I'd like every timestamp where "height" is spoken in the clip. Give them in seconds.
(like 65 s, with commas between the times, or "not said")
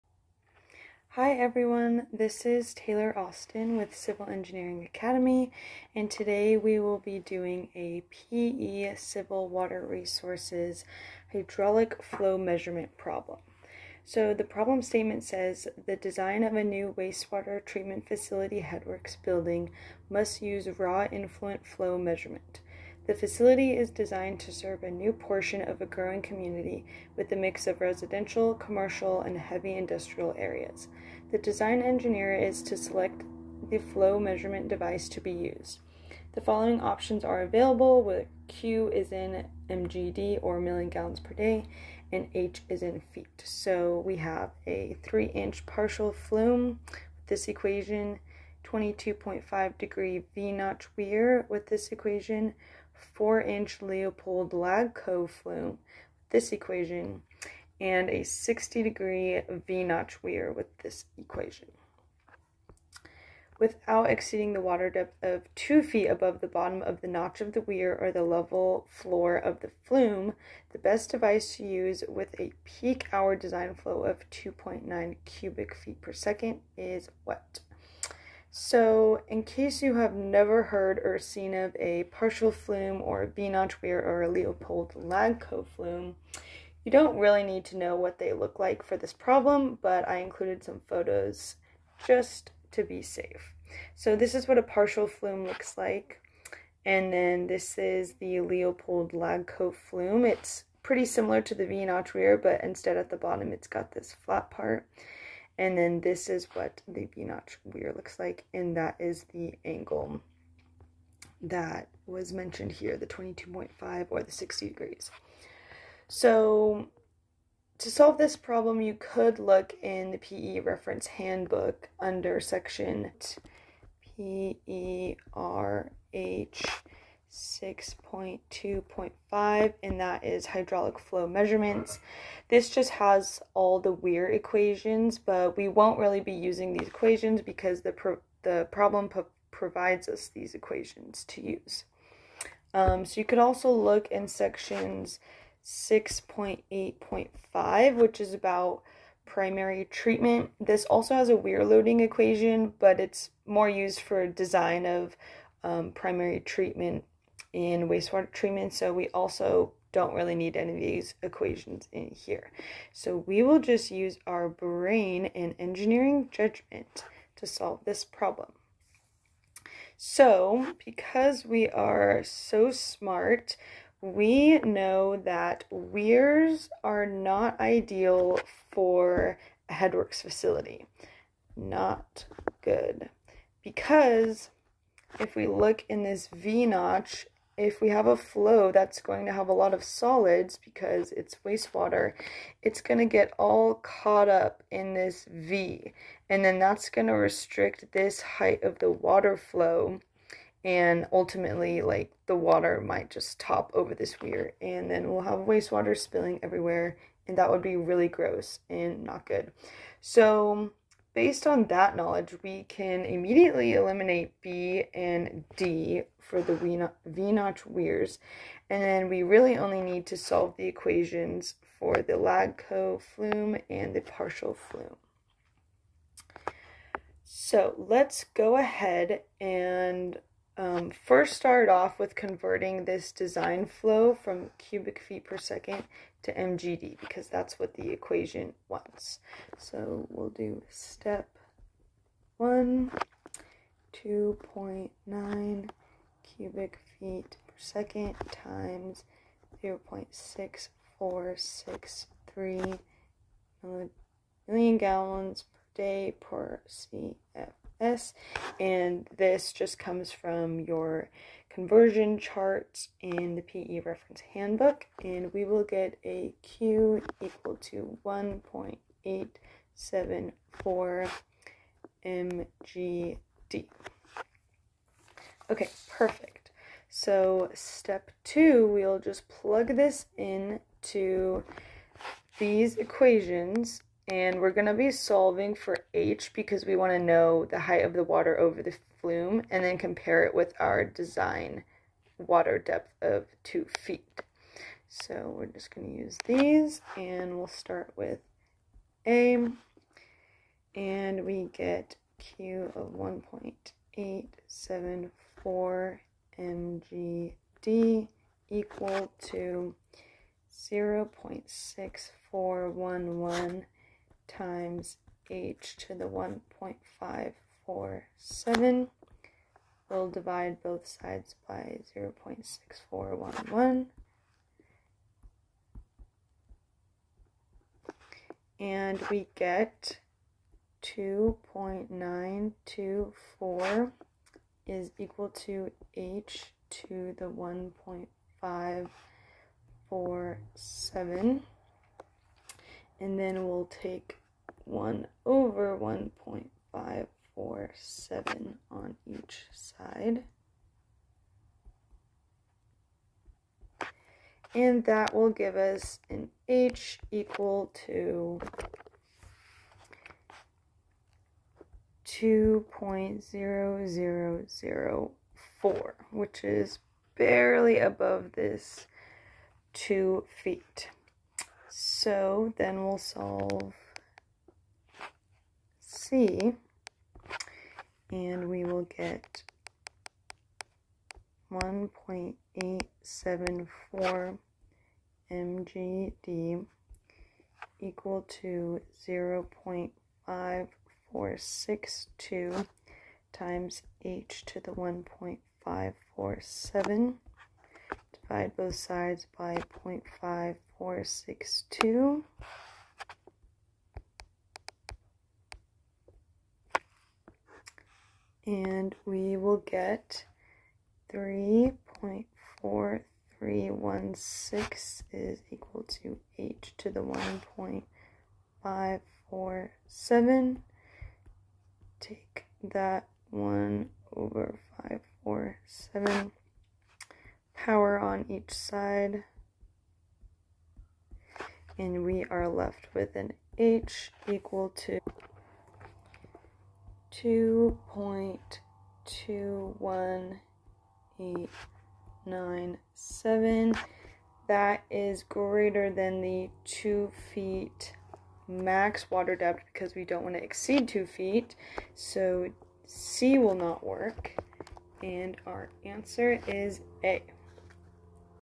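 198 s, 287 s.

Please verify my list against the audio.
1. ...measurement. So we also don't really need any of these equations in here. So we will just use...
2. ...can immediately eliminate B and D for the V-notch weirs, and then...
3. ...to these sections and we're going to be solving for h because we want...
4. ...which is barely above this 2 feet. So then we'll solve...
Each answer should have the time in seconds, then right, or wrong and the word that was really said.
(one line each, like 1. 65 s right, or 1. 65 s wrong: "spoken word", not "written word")
1. 158 s wrong: "treatment", not "measurement"
2. 212 s right
3. 280 s wrong: "equations", not "sections"
4. 366 s right.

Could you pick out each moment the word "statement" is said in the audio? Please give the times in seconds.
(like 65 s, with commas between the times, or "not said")
14 s.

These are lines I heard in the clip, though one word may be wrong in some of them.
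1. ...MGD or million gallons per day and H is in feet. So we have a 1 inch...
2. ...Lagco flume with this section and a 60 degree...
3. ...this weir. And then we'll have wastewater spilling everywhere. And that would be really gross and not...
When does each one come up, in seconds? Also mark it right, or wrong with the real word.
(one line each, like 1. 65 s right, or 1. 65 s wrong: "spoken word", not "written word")
1. 39 s wrong: "3", not "1"
2. 54 s wrong: "equation", not "section"
3. 203 s right.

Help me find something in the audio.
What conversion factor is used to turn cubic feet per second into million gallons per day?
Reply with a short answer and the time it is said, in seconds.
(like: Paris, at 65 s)
0.6463, at 249 s.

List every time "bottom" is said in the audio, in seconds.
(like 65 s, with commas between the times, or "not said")
66 s, 103 s.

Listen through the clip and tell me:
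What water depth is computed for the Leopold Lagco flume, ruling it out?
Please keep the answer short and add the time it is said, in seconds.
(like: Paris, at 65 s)
2.21897, at 437 s.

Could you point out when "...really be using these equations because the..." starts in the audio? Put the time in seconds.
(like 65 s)
135 s.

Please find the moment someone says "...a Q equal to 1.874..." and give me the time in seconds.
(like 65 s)
266 s.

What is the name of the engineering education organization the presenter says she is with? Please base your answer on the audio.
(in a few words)
Civil Engineering Academy.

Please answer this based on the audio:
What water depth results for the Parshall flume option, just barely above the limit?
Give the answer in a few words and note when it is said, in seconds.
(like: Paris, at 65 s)
2.0004, at 362 s.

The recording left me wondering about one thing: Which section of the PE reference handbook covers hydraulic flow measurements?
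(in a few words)
6.2.5.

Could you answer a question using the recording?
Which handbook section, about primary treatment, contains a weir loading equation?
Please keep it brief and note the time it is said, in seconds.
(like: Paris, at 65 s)
6.8.5, at 145 s.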